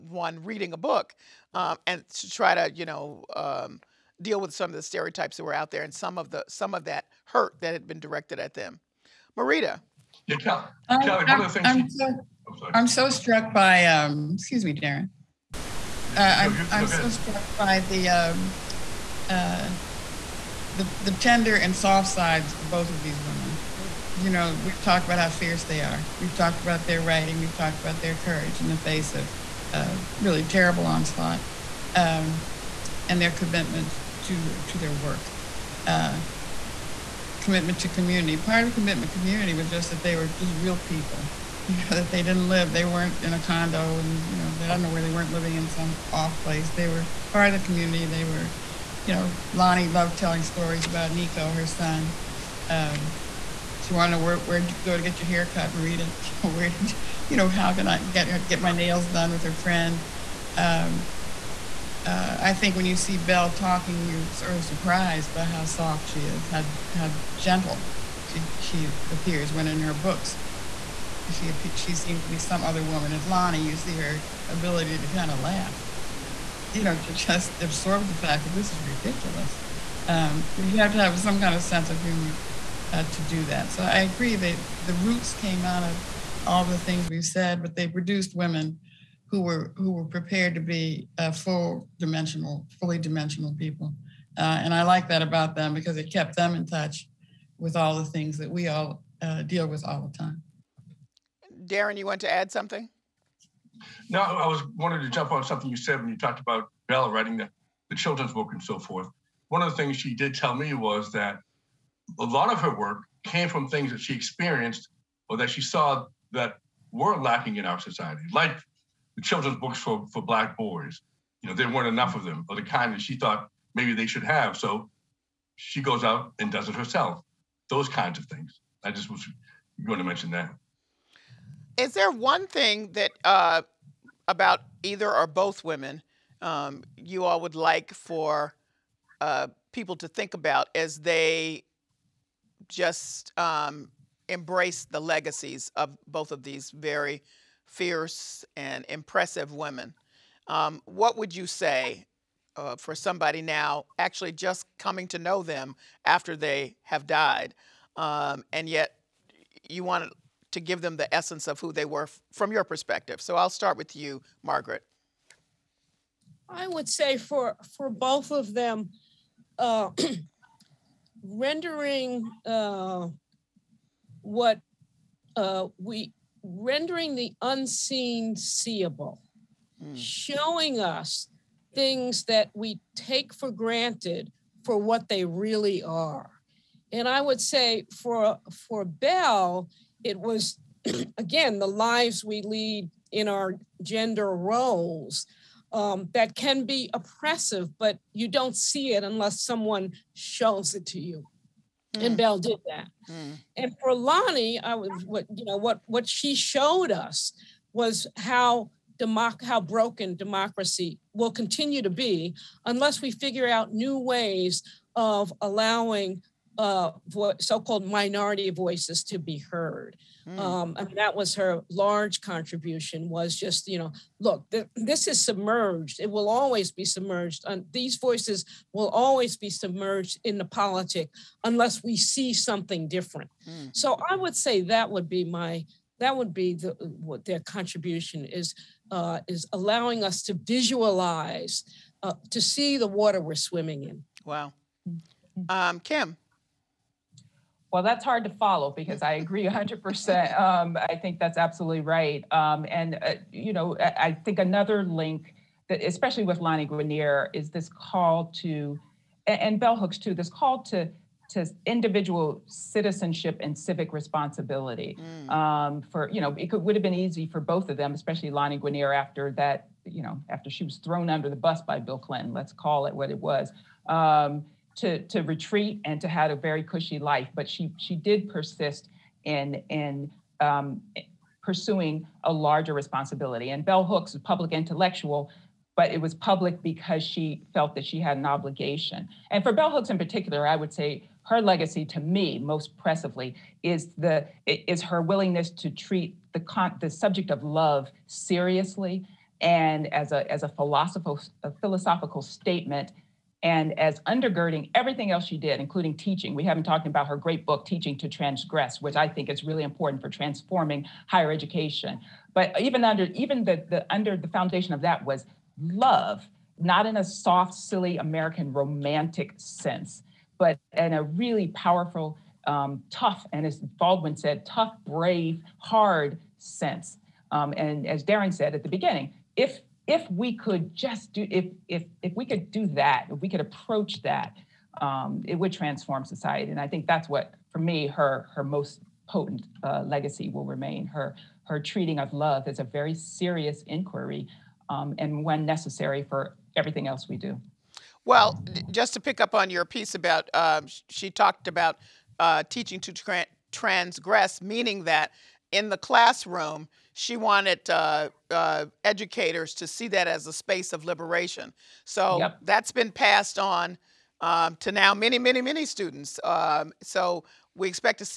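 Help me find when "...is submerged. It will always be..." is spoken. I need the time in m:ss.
3:45.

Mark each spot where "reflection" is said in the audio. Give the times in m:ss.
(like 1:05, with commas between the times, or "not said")
not said.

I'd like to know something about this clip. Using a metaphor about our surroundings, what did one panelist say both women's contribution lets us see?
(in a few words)
the water we're swimming in.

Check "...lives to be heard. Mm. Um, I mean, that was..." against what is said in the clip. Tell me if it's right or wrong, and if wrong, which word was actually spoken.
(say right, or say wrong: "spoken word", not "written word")
wrong: "voices", not "lives".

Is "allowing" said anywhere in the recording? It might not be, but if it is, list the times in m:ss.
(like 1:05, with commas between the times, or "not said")
3:35, 3:59.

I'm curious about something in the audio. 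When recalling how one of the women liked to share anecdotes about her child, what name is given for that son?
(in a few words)
Nico.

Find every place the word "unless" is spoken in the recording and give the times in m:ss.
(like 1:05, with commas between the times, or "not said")
3:19, 3:32, 3:51.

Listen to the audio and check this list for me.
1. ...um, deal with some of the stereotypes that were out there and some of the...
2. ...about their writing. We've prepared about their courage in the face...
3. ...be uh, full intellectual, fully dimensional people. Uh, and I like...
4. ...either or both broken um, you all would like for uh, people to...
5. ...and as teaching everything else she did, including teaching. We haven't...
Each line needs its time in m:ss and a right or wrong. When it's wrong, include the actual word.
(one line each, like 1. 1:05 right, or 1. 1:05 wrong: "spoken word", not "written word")
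1. 0:03 right
2. 0:26 wrong: "talked", not "prepared"
3. 1:30 wrong: "dimensional", not "intellectual"
4. 2:14 wrong: "women", not "broken"
5. 5:03 wrong: "undergirding", not "teaching".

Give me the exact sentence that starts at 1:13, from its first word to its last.
As Lani, you see her ability to kind of laugh you know, to just absorb the fact that this is ridiculous.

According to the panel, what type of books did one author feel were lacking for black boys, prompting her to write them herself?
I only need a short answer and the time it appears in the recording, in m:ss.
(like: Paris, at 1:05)
children's books, at 1:59.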